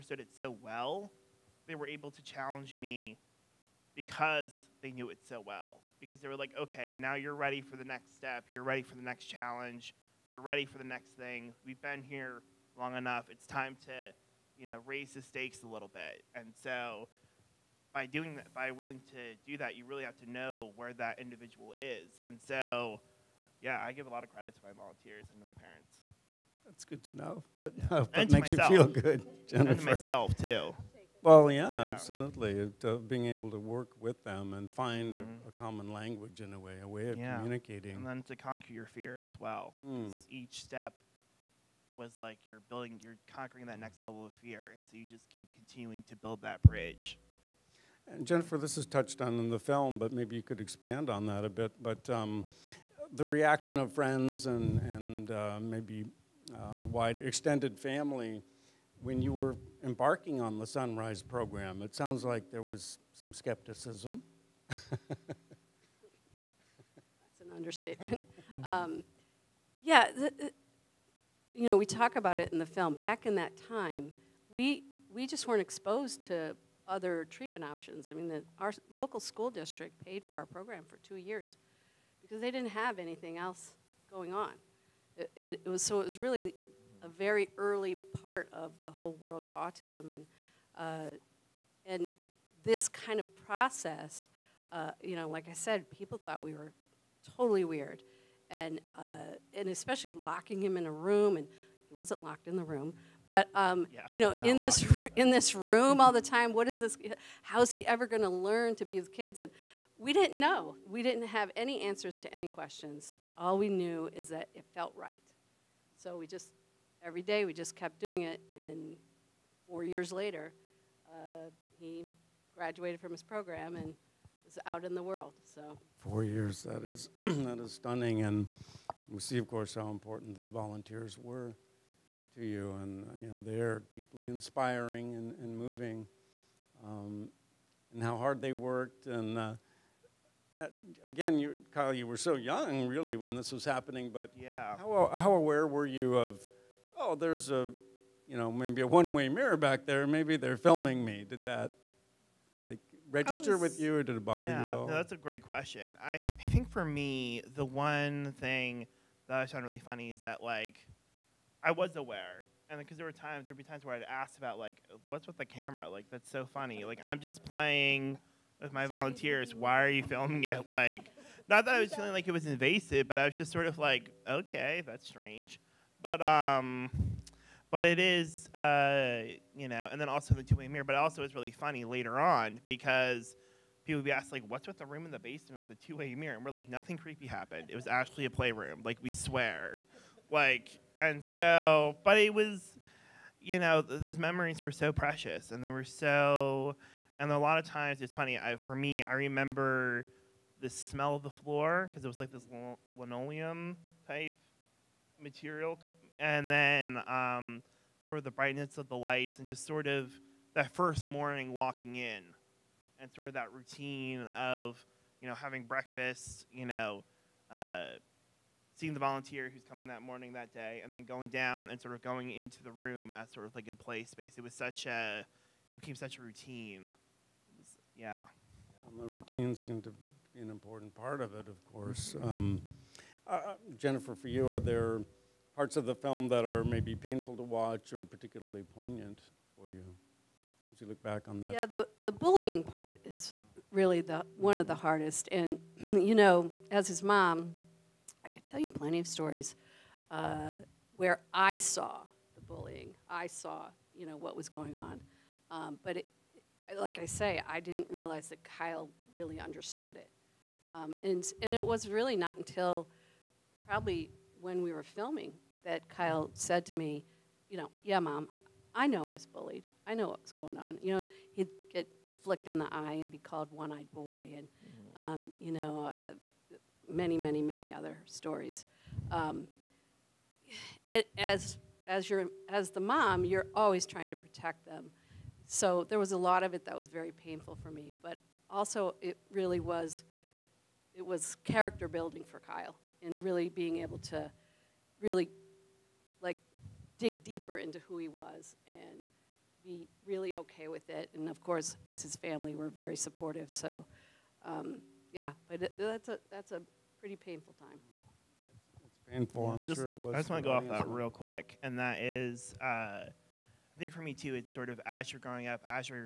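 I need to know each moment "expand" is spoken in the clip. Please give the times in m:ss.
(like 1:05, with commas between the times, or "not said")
0:50.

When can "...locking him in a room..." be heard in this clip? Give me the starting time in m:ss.
1:40.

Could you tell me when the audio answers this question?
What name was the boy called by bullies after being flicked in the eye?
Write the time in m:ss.
4:33.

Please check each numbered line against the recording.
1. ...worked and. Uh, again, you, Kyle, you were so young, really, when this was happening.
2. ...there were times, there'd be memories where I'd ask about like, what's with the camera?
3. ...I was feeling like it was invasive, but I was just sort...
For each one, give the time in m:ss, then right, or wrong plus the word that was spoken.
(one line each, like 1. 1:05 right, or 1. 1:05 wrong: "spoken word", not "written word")
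1. 2:18 right
2. 2:42 wrong: "times", not "memories"
3. 2:51 right.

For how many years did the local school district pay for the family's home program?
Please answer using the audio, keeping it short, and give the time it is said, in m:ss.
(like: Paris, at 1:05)
2, at 1:21.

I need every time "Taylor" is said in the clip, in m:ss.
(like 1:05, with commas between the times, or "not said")
not said.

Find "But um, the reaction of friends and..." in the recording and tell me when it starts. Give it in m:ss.
0:51.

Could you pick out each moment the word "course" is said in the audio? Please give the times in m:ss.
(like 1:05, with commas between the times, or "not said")
2:09, 3:51, 5:01.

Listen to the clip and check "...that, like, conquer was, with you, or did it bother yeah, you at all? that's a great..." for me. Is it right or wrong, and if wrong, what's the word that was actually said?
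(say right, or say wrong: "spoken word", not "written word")
wrong: "register", not "conquer".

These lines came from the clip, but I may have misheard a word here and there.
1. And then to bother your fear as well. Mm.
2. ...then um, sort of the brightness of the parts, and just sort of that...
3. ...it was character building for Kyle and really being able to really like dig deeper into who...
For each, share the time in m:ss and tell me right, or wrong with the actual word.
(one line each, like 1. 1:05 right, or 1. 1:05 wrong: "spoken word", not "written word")
1. 0:37 wrong: "conquer", not "bother"
2. 3:26 wrong: "lights", not "parts"
3. 4:50 right.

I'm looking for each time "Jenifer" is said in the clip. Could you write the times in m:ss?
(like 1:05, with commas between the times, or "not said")
0:29, 0:48.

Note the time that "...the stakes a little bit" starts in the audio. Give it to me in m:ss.
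0:15.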